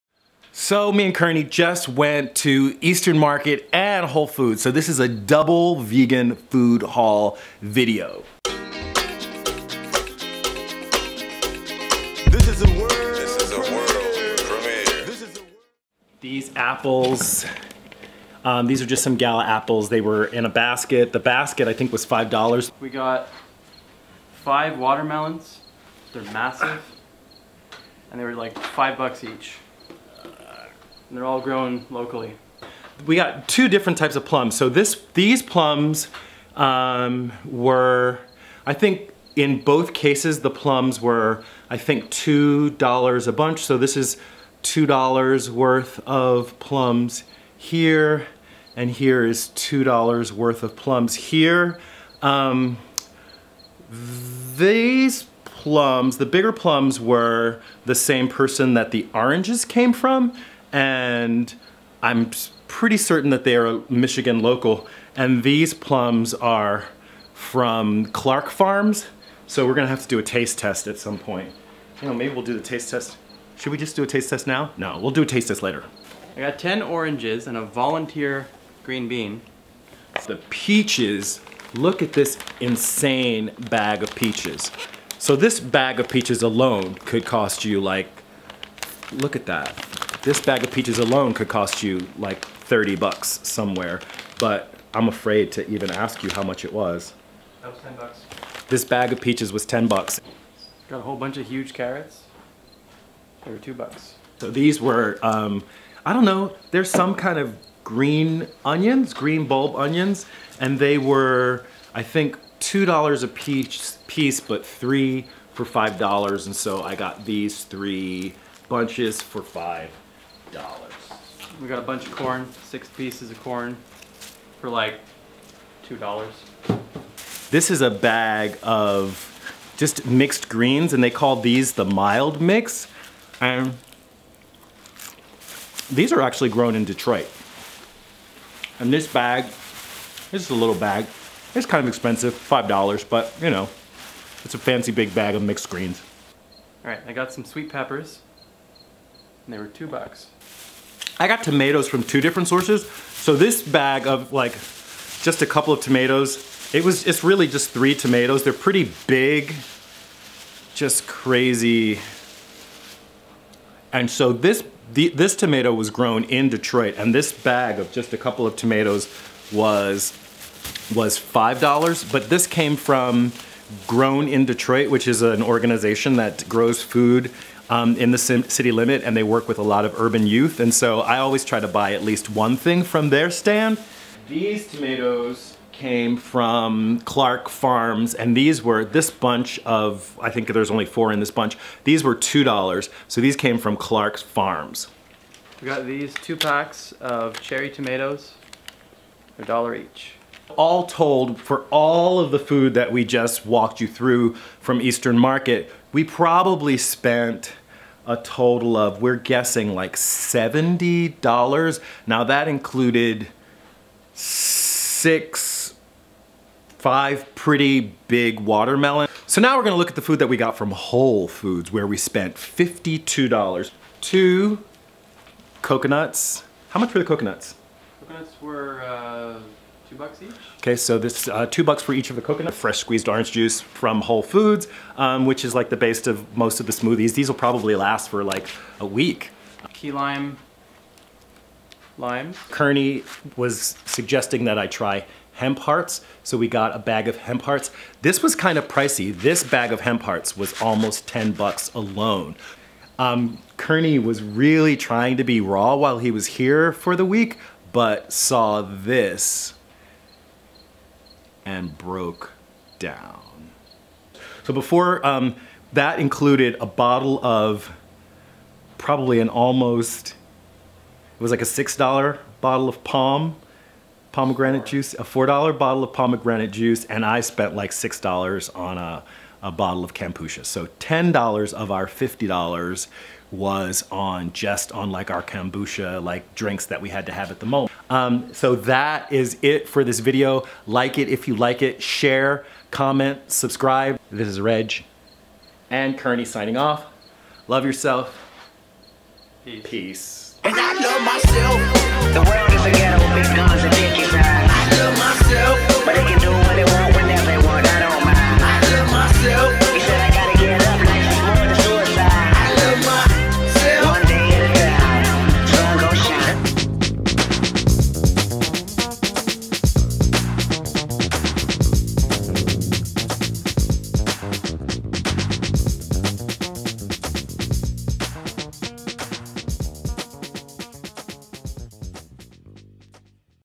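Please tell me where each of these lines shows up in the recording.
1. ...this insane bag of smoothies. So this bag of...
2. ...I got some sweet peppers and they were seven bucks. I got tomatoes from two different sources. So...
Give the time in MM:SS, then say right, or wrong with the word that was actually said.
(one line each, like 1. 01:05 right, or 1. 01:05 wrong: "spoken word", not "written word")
1. 01:22 wrong: "peaches", not "smoothies"
2. 02:27 wrong: "two", not "seven".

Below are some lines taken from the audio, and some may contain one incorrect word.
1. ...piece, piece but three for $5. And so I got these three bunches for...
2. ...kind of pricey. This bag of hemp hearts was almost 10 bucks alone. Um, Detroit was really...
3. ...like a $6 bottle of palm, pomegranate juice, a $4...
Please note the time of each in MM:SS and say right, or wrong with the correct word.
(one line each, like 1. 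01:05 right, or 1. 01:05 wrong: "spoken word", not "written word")
1. 01:53 right
2. 04:08 wrong: "Kearney", not "Detroit"
3. 04:31 right.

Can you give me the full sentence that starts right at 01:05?
And these plums are from Clark Farms.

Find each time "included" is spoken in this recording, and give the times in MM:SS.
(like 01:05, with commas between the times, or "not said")
03:32, 04:25.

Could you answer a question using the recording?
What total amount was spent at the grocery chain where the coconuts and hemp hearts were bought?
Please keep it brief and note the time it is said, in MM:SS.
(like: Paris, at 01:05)
$52, at 03:42.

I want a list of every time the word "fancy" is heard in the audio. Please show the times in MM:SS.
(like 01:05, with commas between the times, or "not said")
02:24.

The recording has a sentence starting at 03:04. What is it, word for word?
These tomatoes came from Clark Farms and these were this bunch of, I think there's only four in this bunch.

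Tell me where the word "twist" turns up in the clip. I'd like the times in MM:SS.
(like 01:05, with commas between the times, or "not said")
not said.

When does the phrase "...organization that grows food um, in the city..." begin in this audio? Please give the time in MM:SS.
02:55.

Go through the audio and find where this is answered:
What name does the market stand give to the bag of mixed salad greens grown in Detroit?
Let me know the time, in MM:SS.
02:11.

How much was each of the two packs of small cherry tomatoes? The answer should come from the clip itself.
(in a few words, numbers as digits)
$1.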